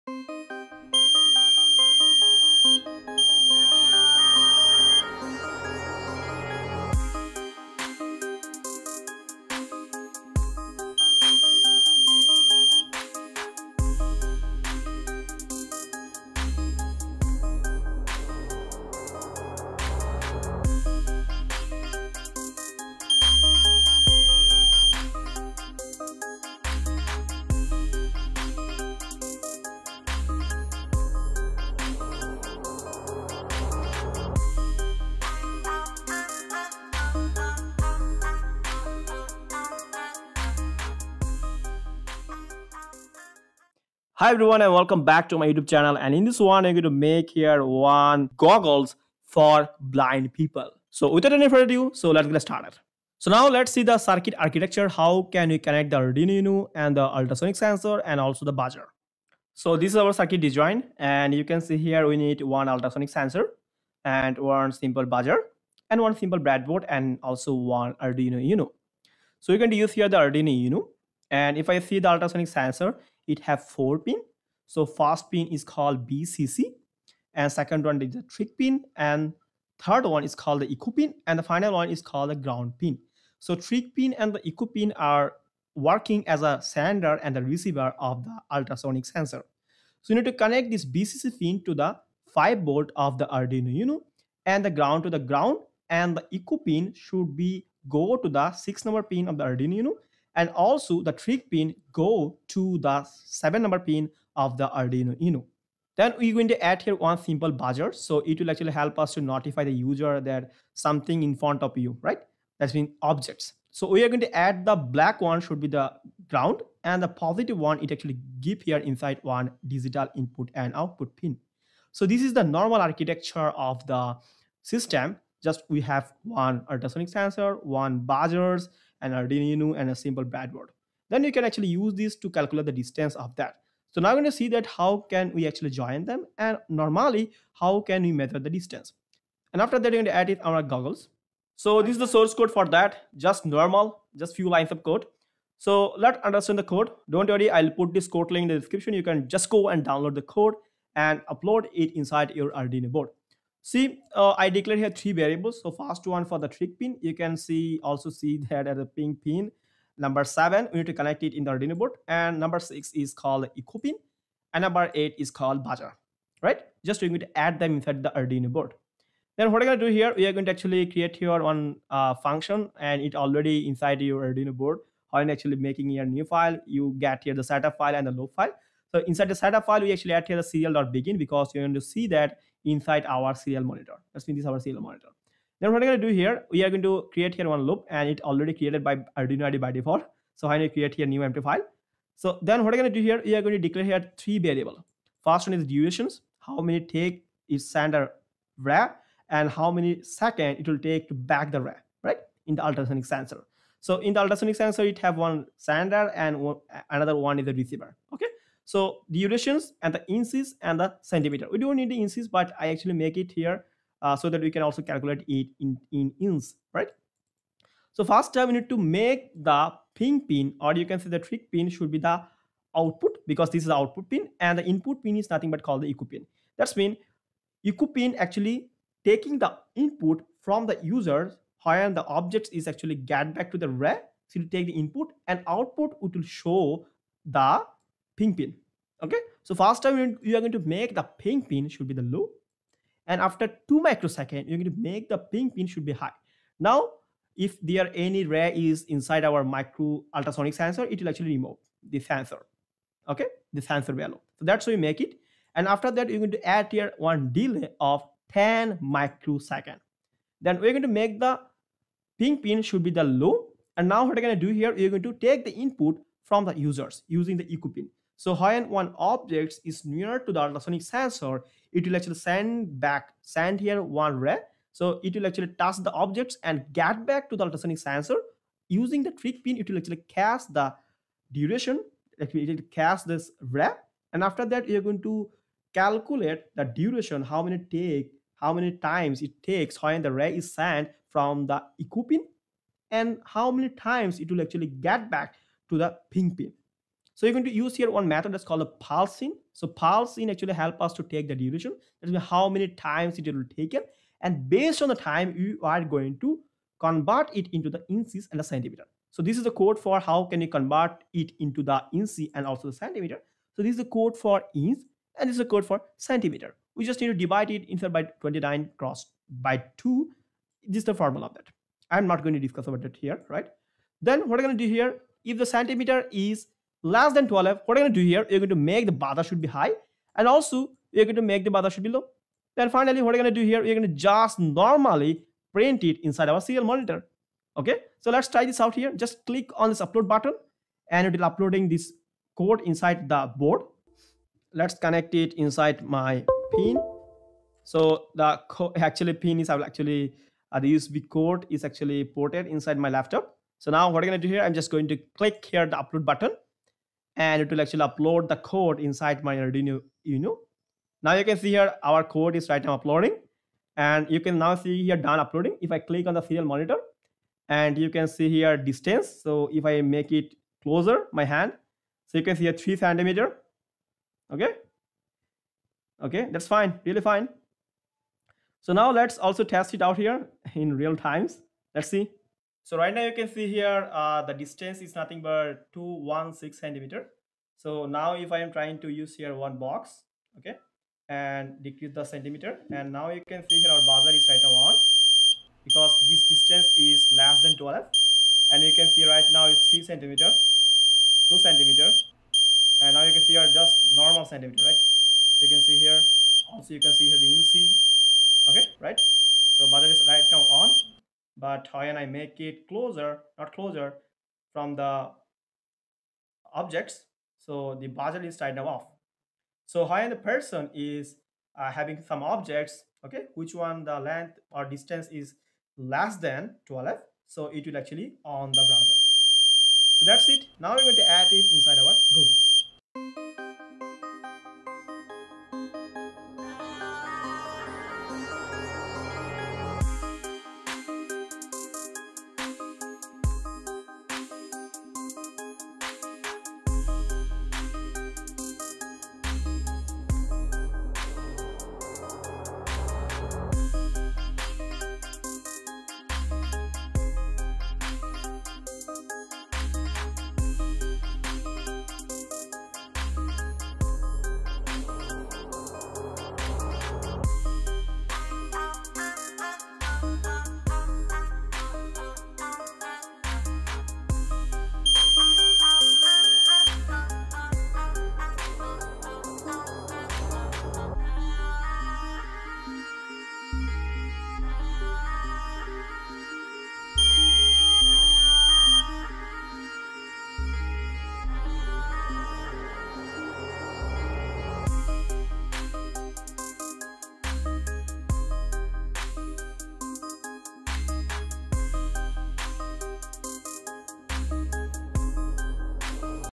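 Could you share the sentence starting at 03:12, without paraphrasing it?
So then what I'm going to do here, we are going to declare here three variable.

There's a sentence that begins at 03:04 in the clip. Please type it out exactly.
Let's make this our serial monitor.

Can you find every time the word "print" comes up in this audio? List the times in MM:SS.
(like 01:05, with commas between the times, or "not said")
05:35.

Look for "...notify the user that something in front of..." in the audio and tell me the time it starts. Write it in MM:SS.
01:49.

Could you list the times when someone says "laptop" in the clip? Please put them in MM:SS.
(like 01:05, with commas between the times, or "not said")
05:52.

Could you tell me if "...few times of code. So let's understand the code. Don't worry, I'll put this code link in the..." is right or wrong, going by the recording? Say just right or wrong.
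wrong.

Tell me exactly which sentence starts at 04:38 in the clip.
Using the trig pin, it will actually cast the duration, it will cast this ray.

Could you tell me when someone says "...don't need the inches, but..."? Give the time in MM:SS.
03:31.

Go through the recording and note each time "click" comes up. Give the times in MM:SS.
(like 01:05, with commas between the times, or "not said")
05:39, 05:55, 06:05.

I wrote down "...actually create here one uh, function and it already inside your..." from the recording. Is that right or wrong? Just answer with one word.
right.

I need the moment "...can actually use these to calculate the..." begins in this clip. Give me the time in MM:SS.
02:11.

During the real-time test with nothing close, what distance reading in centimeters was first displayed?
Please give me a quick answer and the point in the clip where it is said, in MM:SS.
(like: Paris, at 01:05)
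216, at 06:25.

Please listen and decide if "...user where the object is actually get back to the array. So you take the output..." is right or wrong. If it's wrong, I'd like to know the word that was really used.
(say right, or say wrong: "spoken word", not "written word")
wrong: "input", not "output".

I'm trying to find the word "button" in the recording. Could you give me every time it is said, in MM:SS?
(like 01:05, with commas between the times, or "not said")
05:40, 05:56.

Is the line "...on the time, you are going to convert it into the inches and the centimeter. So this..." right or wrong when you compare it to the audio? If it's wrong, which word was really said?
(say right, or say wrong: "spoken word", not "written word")
right.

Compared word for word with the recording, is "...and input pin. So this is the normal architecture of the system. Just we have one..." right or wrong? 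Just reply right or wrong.
wrong.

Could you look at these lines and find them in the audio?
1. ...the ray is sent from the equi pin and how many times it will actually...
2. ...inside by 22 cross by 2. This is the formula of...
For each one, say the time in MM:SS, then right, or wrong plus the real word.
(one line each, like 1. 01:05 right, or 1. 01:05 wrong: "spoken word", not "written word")
1. 04:50 right
2. 05:17 wrong: "29", not "22".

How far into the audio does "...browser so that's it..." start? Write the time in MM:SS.
07:08.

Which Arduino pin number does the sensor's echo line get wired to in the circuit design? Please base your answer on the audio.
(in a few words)
6.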